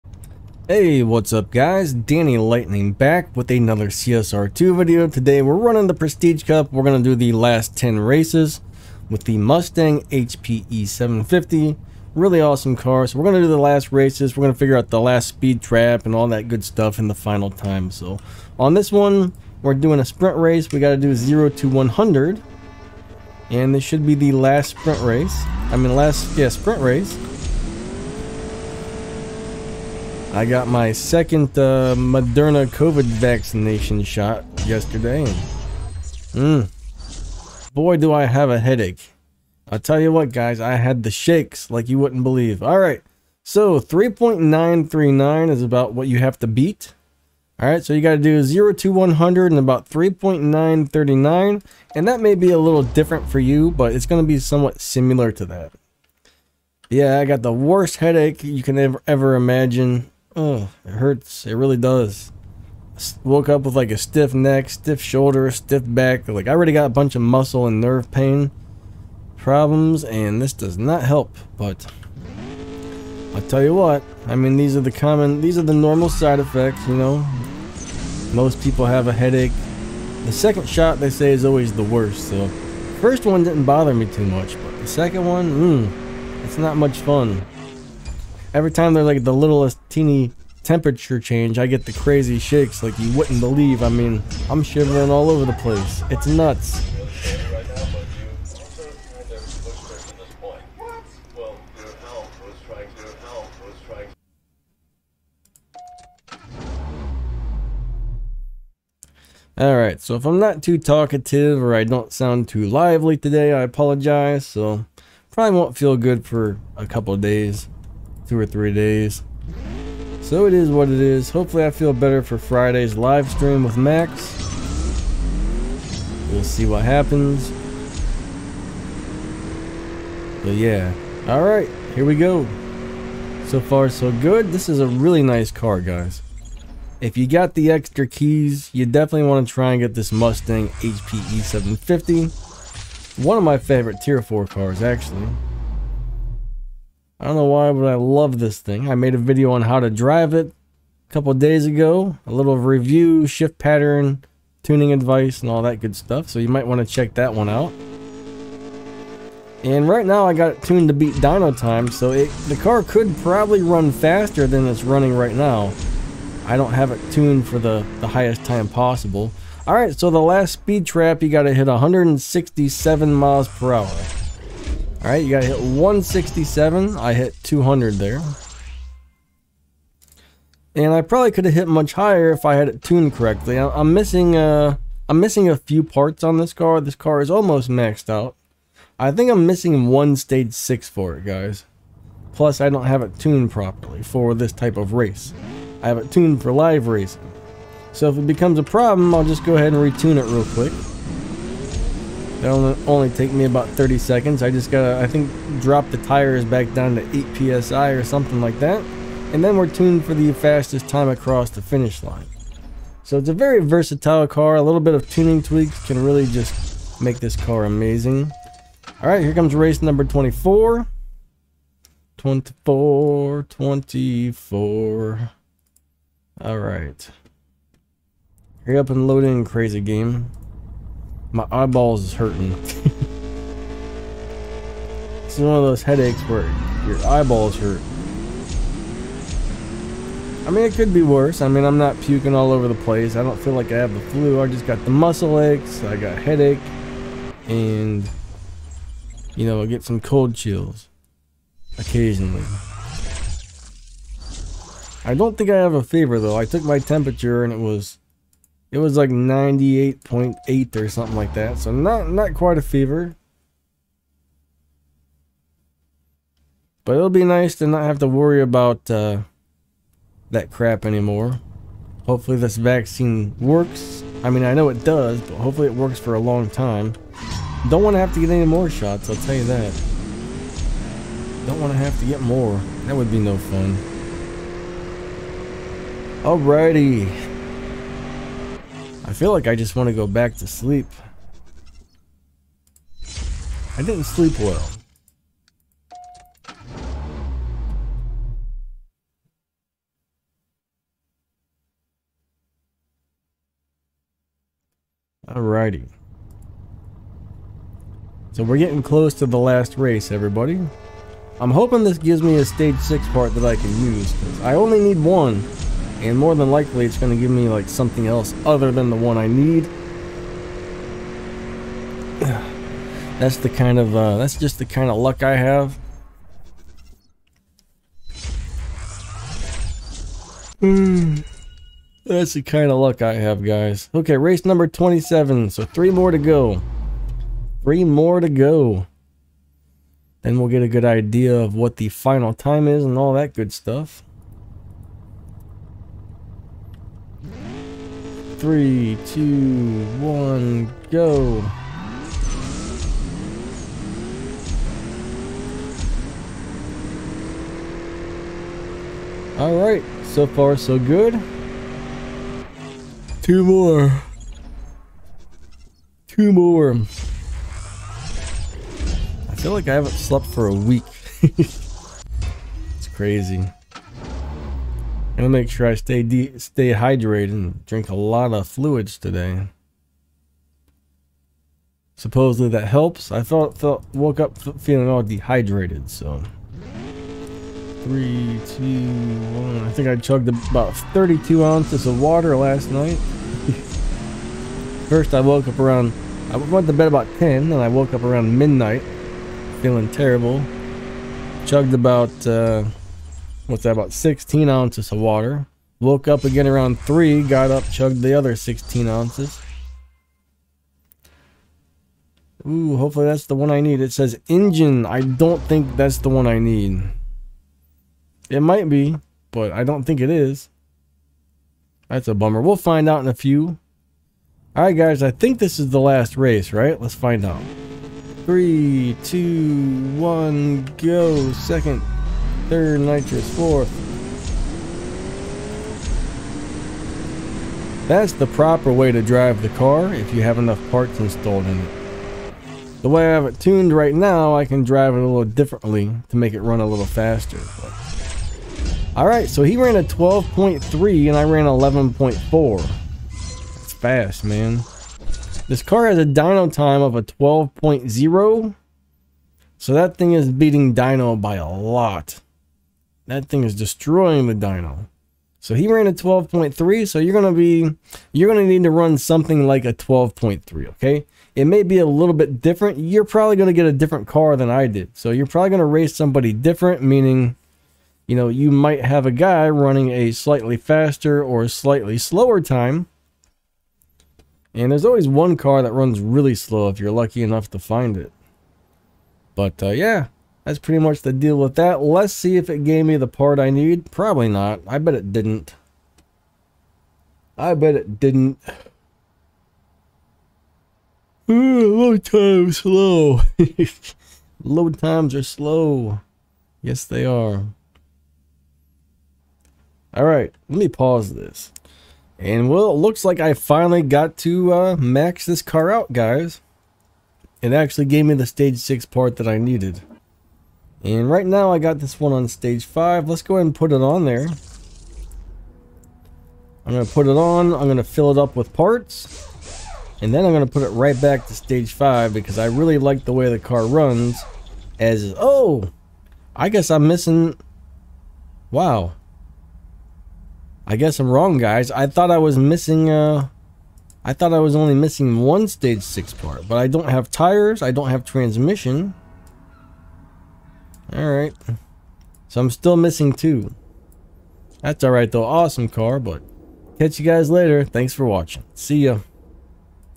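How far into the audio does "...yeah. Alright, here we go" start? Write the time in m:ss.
2:10.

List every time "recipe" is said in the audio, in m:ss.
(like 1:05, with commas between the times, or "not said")
not said.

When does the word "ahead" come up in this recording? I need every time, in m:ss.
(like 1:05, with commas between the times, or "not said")
3:19, 8:43.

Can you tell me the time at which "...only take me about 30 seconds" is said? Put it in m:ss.
3:22.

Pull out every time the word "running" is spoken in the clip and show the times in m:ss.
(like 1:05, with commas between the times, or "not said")
0:05, 2:44, 7:59.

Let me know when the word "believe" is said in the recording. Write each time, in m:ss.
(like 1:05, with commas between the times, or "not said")
0:42, 1:33.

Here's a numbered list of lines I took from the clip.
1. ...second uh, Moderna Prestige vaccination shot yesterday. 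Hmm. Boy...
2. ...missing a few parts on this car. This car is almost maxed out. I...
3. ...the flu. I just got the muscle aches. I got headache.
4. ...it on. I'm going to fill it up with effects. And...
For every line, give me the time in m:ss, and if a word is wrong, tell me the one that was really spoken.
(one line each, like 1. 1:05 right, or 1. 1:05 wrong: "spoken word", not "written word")
1. 0:30 wrong: "COVID", not "Prestige"
2. 3:05 right
3. 4:03 right
4. 8:47 wrong: "parts", not "effects".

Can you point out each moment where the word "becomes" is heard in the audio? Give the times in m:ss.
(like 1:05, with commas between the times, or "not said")
3:18.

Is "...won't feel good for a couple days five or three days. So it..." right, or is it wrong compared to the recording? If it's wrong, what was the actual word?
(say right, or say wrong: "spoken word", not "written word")
wrong: "two", not "five".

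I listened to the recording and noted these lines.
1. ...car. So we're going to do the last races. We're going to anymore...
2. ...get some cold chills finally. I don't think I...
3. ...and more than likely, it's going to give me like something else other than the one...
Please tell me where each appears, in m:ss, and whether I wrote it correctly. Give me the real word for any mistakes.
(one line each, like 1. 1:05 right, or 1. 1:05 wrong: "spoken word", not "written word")
1. 0:12 wrong: "figure", not "anymore"
2. 4:09 wrong: "occasionally", not "finally"
3. 5:16 right.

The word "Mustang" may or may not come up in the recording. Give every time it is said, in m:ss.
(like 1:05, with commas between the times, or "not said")
0:09, 2:20.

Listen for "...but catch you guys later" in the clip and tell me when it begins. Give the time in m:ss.
9:15.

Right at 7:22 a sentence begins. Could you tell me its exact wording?
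The way I have it tuned right now, I can drive it a little differently to make it run a little faster.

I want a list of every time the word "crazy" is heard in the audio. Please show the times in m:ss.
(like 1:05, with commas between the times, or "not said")
1:31, 3:49, 6:12.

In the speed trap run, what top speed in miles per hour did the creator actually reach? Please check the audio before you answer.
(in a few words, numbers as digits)
200.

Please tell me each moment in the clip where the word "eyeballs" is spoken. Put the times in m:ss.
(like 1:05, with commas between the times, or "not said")
3:51, 3:57.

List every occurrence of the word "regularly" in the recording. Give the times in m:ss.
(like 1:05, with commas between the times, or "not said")
not said.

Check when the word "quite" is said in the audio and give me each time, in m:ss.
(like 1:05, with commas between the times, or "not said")
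4:22.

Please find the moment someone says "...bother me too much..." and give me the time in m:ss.
1:23.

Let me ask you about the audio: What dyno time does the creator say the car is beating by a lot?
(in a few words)
12.0.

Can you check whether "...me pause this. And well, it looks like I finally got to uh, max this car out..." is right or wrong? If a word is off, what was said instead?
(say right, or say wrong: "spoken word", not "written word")
right.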